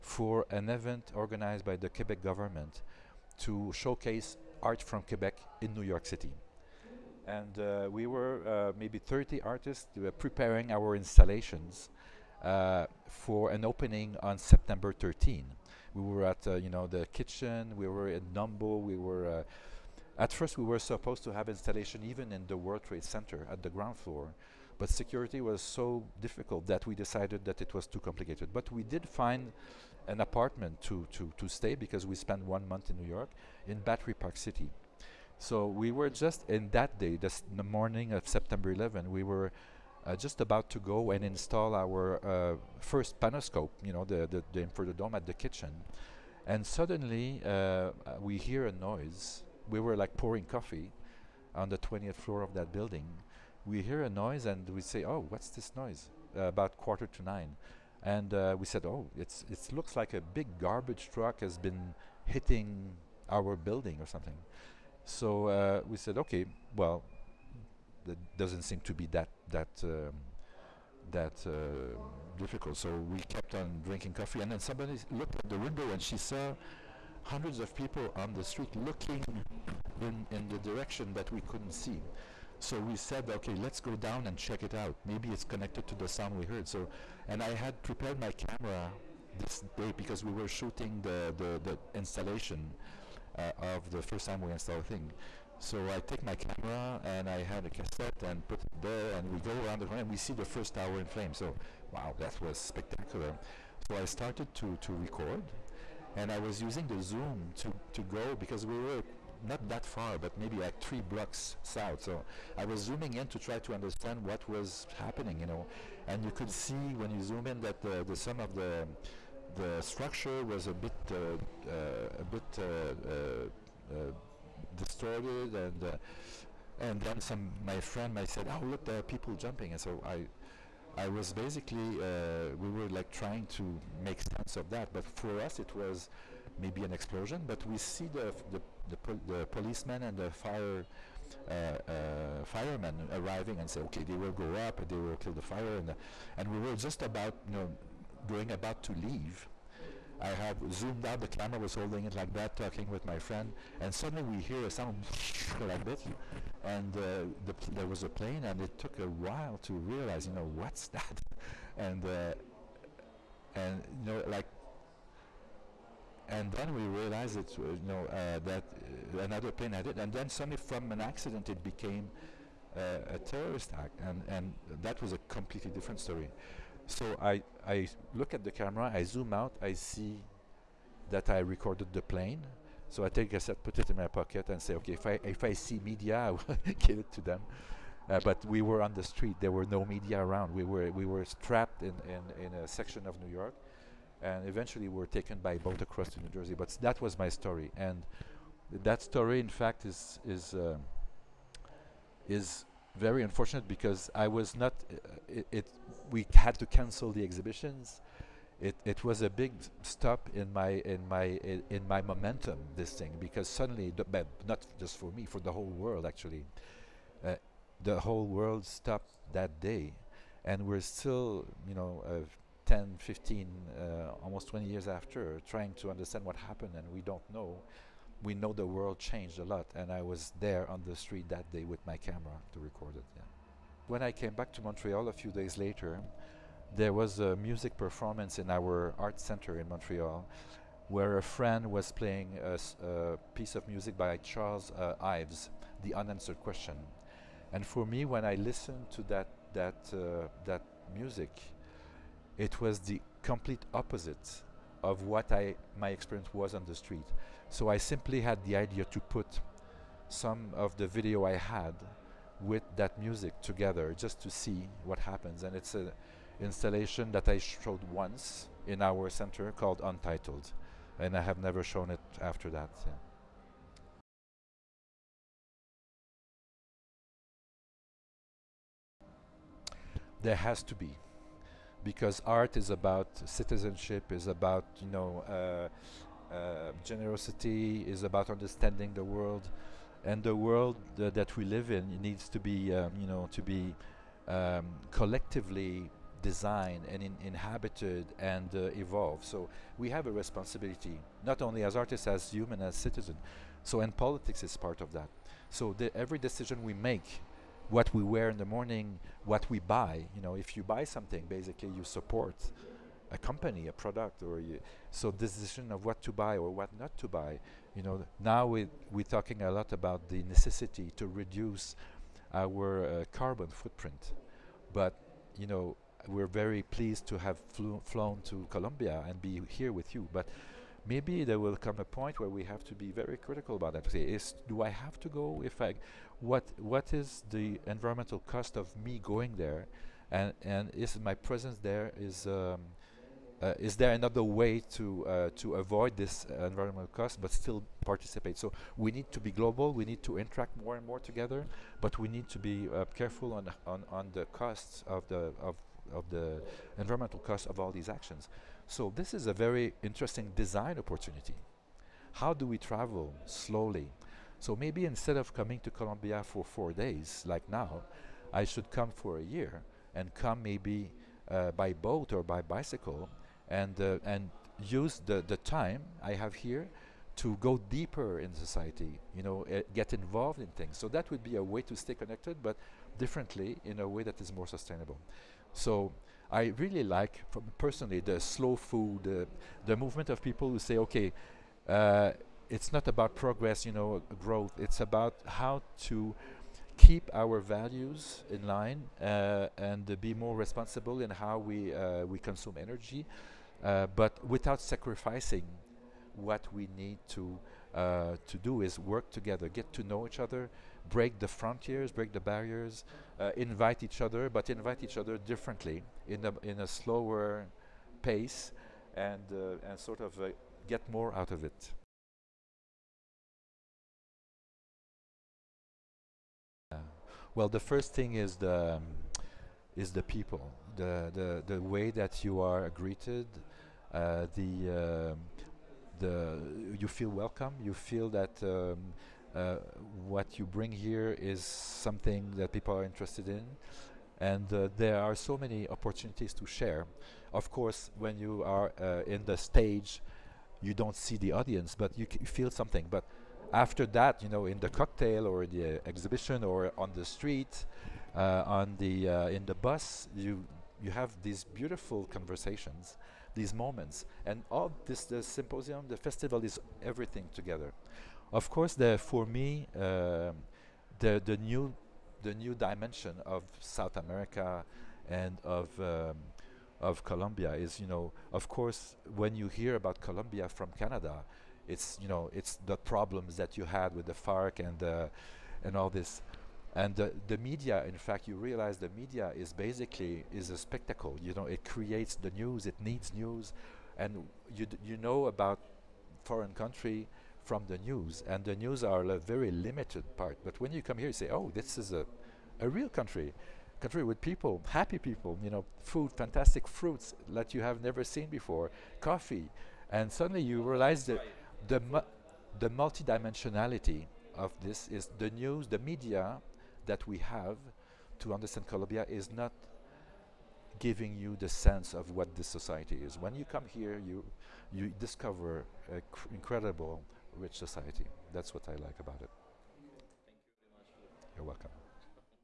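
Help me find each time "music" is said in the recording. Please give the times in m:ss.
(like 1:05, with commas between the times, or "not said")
3:57, 4:03, 4:10, 4:22.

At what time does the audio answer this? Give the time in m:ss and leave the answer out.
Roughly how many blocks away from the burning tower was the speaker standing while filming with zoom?
1:50.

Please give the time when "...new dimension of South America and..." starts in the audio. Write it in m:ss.
7:52.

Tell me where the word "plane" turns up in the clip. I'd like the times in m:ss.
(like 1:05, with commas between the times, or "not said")
2:38, 2:49, 3:02.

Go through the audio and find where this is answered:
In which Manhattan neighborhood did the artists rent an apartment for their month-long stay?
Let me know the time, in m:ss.
0:33.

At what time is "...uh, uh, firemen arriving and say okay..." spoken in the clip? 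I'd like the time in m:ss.
2:21.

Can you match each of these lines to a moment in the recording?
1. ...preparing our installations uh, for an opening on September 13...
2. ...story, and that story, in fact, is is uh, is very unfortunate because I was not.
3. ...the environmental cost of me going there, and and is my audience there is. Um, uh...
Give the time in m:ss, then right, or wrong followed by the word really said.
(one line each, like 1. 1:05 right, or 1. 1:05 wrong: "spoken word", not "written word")
1. 0:10 right
2. 3:17 right
3. 5:37 wrong: "presence", not "audience".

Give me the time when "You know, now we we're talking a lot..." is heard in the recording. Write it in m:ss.
5:17.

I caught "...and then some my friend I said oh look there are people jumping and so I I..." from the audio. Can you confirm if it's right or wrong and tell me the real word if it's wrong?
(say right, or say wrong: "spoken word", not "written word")
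right.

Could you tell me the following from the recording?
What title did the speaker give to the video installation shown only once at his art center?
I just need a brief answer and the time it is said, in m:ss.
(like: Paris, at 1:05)
Untitled, at 4:29.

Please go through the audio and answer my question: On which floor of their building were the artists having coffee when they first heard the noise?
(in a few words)
20th floor.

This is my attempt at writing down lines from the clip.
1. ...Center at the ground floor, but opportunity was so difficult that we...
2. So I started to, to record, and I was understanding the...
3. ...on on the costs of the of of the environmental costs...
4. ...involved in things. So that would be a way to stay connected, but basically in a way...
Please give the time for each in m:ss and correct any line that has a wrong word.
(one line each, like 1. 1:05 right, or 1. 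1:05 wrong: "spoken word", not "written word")
1. 0:23 wrong: "security", not "opportunity"
2. 1:43 wrong: "using", not "understanding"
3. 5:53 right
4. 6:19 wrong: "differently", not "basically".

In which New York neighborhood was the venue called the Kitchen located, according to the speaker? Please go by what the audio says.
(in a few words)
Dumbo.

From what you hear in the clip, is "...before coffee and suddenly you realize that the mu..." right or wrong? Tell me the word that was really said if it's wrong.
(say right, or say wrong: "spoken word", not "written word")
right.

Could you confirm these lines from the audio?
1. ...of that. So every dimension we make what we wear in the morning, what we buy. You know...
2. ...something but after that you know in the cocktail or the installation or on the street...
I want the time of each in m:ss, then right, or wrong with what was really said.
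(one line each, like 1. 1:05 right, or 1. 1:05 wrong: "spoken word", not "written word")
1. 5:04 wrong: "decision", not "dimension"
2. 7:32 wrong: "exhibition", not "installation".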